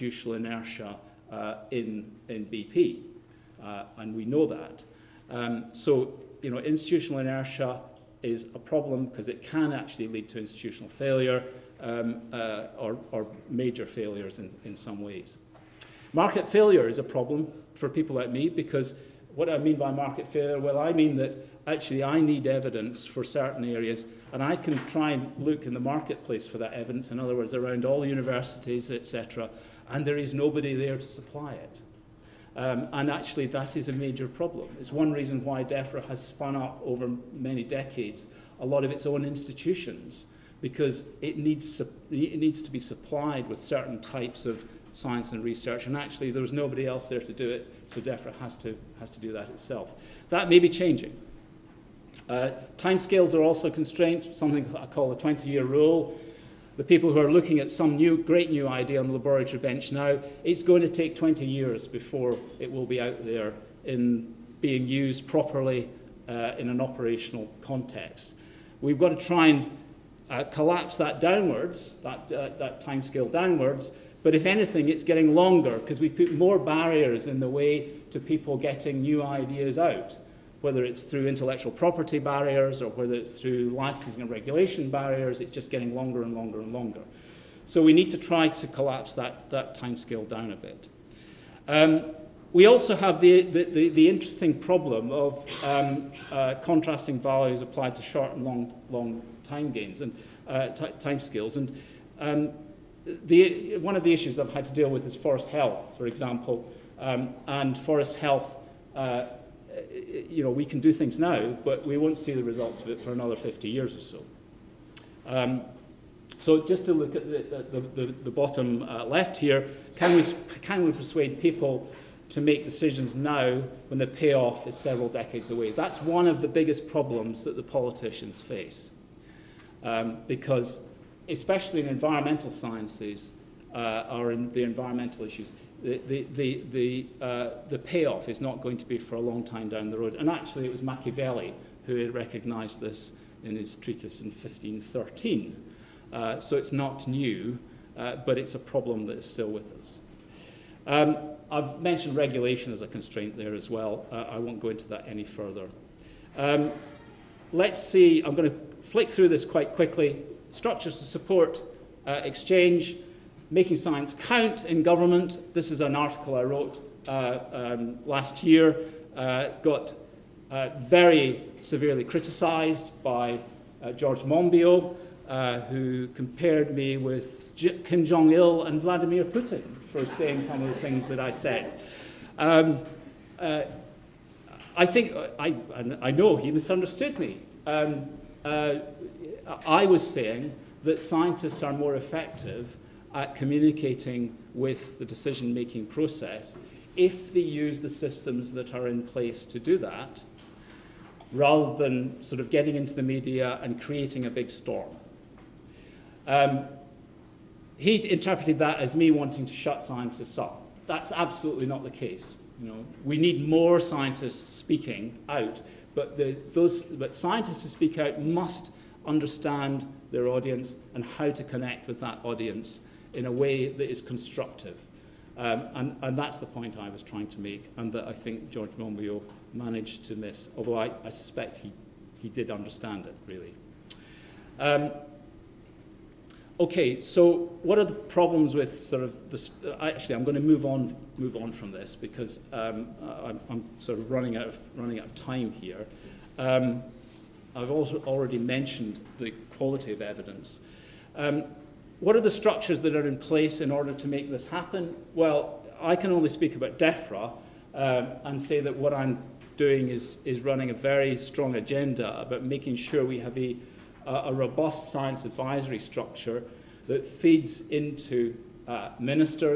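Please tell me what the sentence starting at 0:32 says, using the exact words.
Um, and actually, that is a major problem.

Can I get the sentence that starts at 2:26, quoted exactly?
Uh, so it's not new, uh, but it's a problem that is still with us.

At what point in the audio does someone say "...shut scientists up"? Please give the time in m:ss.
3:29.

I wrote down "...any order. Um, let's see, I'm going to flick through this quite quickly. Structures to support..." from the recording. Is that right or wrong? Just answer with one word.
wrong.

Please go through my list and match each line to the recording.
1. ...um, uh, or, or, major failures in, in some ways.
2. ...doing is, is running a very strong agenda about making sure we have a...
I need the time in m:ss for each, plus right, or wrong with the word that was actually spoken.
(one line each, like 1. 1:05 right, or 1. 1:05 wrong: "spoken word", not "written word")
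1. 0:11 right
2. 4:19 right.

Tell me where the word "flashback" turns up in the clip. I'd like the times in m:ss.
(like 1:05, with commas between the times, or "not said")
not said.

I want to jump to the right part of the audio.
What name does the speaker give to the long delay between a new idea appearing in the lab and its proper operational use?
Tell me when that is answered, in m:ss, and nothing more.
0:55.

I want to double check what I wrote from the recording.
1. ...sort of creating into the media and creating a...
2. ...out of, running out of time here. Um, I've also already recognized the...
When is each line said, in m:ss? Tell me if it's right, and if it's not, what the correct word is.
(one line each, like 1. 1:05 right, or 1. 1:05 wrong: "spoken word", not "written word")
1. 3:22 wrong: "getting", not "creating"
2. 4:04 wrong: "mentioned", not "recognized".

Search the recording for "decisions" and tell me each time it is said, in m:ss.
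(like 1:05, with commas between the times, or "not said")
2:02, 3:15.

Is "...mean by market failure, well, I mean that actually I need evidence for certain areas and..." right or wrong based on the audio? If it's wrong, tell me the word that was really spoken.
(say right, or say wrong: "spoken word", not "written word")
right.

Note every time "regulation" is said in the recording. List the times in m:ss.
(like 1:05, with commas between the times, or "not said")
1:24, 2:32.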